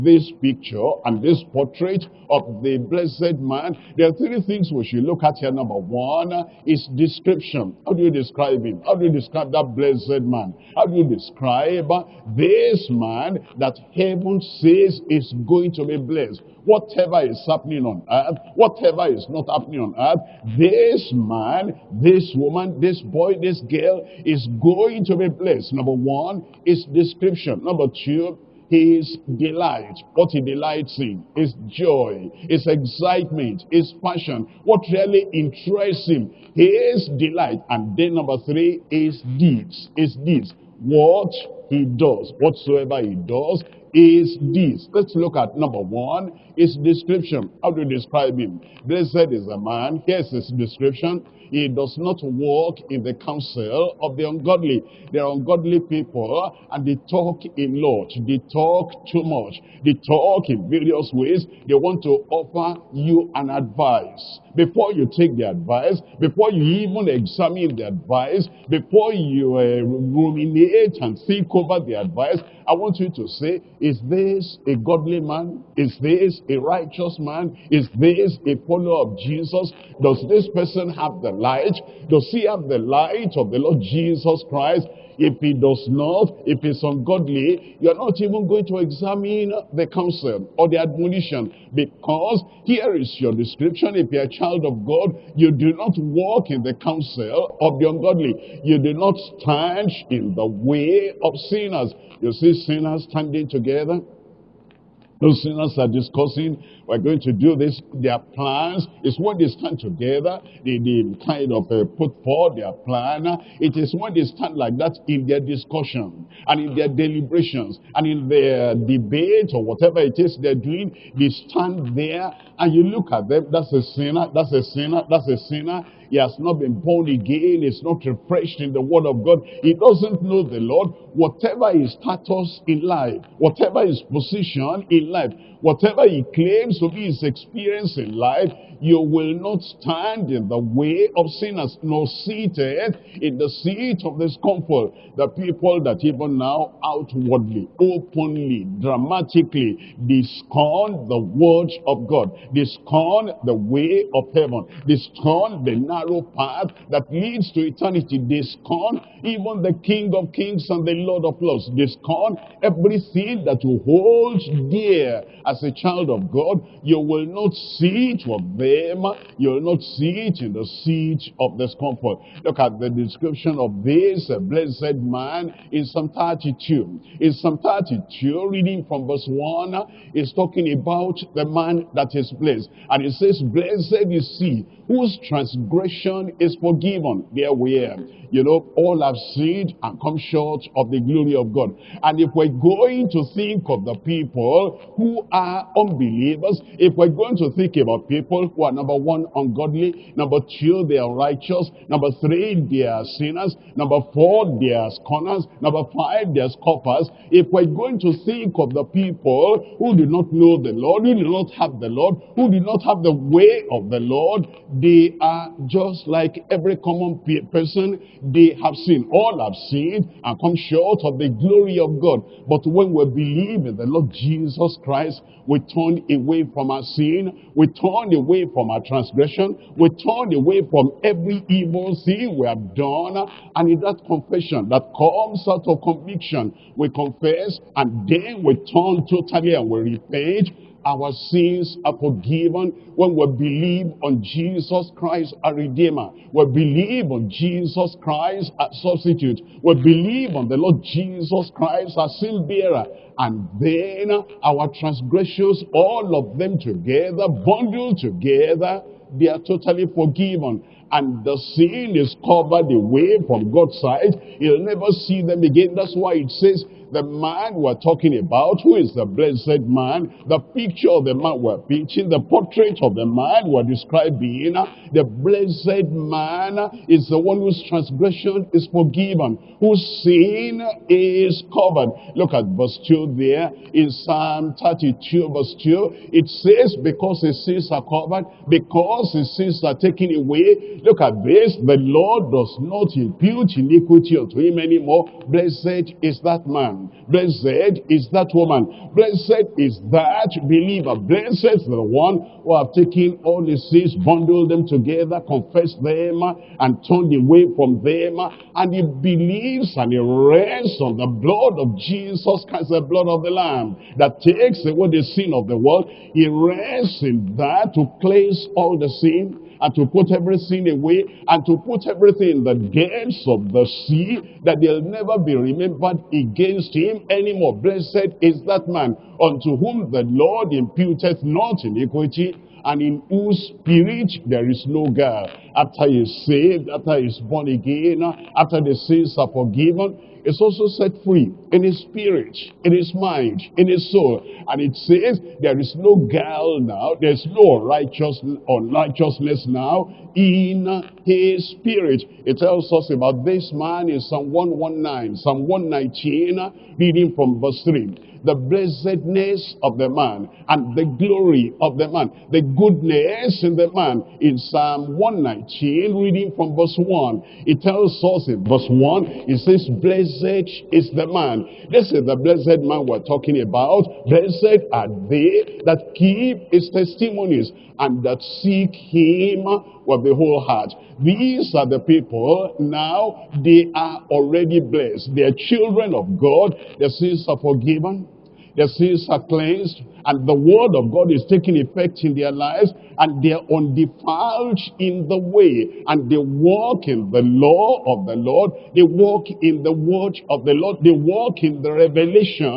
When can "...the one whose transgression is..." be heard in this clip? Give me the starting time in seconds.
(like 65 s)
277 s.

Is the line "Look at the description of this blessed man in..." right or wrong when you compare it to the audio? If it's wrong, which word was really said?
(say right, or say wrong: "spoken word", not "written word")
right.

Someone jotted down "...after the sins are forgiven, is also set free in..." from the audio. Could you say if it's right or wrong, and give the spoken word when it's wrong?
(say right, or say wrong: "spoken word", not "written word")
right.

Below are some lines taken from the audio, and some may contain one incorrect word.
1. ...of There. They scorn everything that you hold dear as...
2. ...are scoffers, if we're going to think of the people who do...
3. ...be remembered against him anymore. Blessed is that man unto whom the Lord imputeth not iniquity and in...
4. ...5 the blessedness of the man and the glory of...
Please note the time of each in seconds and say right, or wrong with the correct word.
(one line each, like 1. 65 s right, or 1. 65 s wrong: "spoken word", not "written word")
1. 161 s wrong: "Lords", not "There"
2. 206 s right
3. 325 s right
4. 357 s wrong: "3", not "5".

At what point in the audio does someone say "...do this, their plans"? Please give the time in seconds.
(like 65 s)
107 s.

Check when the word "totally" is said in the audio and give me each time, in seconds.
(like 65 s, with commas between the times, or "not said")
239 s, 259 s.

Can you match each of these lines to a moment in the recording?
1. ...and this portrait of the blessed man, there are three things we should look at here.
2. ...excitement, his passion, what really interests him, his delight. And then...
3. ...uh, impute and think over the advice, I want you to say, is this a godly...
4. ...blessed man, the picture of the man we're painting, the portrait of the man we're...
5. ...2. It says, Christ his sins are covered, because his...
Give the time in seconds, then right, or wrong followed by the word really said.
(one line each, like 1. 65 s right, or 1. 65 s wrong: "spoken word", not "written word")
1. 1 s right
2. 32 s right
3. 69 s wrong: "ruminate", not "impute"
4. 269 s right
5. 285 s wrong: "Because", not "Christ".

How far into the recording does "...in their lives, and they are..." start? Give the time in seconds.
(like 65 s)
392 s.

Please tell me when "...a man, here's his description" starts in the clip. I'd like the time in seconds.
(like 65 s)
49 s.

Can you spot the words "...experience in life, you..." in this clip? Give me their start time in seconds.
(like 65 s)
137 s.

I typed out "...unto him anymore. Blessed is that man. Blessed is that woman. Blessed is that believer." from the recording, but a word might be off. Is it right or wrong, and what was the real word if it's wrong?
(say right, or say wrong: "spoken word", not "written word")
right.